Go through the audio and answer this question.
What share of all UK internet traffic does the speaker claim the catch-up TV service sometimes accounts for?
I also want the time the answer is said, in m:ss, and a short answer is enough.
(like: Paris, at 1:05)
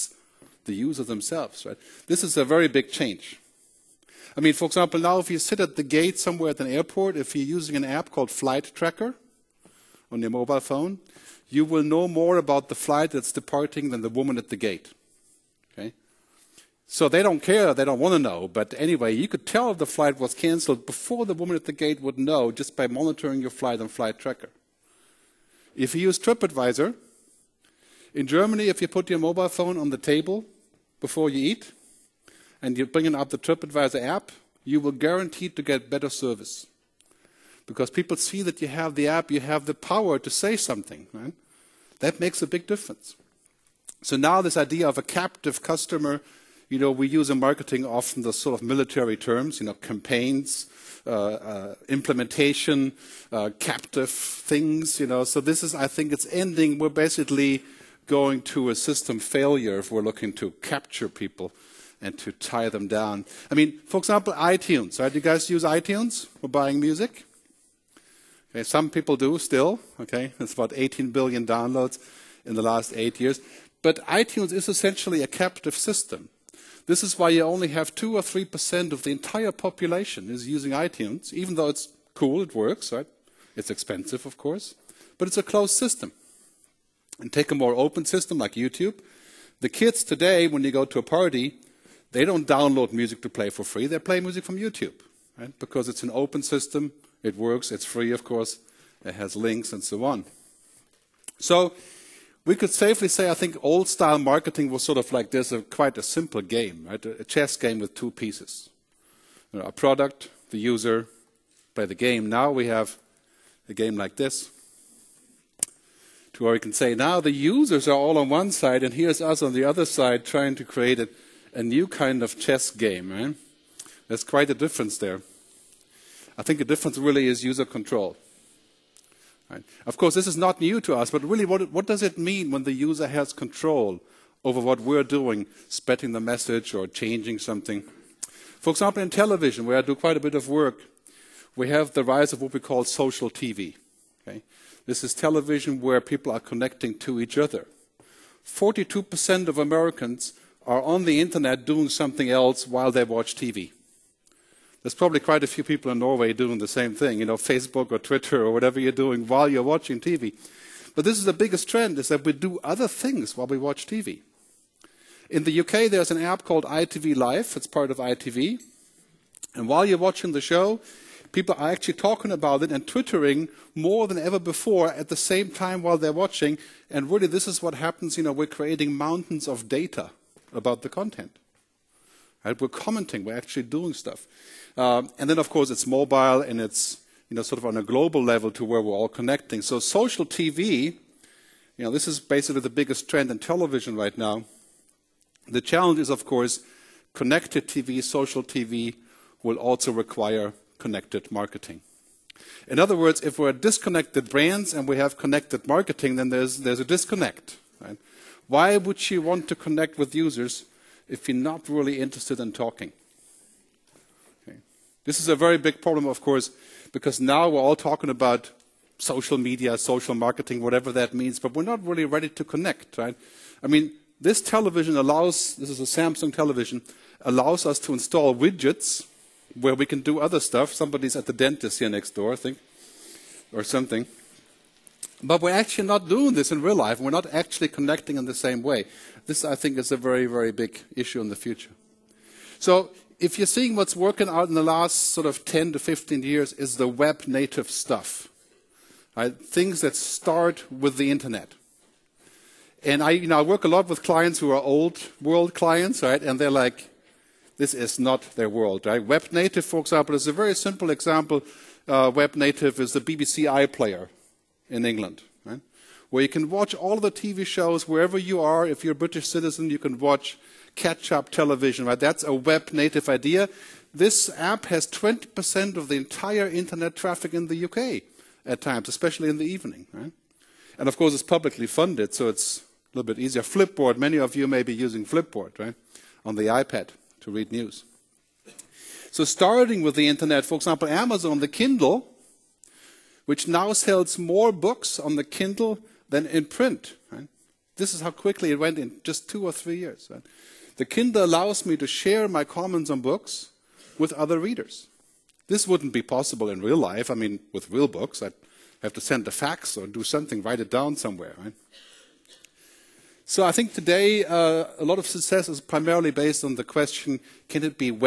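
20%, at 4:34.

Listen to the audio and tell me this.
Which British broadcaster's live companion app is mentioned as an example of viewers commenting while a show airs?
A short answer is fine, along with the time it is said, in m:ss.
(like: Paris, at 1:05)
ITV Live, at 2:46.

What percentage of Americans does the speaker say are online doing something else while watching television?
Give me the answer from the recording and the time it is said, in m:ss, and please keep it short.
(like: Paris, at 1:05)
42%, at 2:28.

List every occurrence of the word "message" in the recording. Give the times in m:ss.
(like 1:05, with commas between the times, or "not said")
2:16.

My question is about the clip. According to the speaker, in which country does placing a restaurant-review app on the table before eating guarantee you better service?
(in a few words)
Germany.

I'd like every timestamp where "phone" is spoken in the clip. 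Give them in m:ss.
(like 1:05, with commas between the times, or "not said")
0:10, 0:29.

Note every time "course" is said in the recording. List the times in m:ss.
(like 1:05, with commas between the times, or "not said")
1:24, 1:38, 2:09, 3:05, 3:16, 3:36, 4:40.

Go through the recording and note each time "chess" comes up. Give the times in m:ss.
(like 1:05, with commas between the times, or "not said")
1:47, 2:02.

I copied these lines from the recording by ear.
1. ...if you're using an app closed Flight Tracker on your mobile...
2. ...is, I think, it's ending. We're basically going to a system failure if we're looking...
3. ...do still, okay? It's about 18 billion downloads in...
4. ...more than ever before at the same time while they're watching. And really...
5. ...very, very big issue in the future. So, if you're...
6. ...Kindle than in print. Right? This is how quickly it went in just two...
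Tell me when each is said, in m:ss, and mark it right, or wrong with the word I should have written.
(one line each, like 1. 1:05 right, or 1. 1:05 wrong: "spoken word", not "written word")
1. 0:07 wrong: "called", not "closed"
2. 0:55 right
3. 1:09 right
4. 2:53 right
5. 3:59 right
6. 4:55 right.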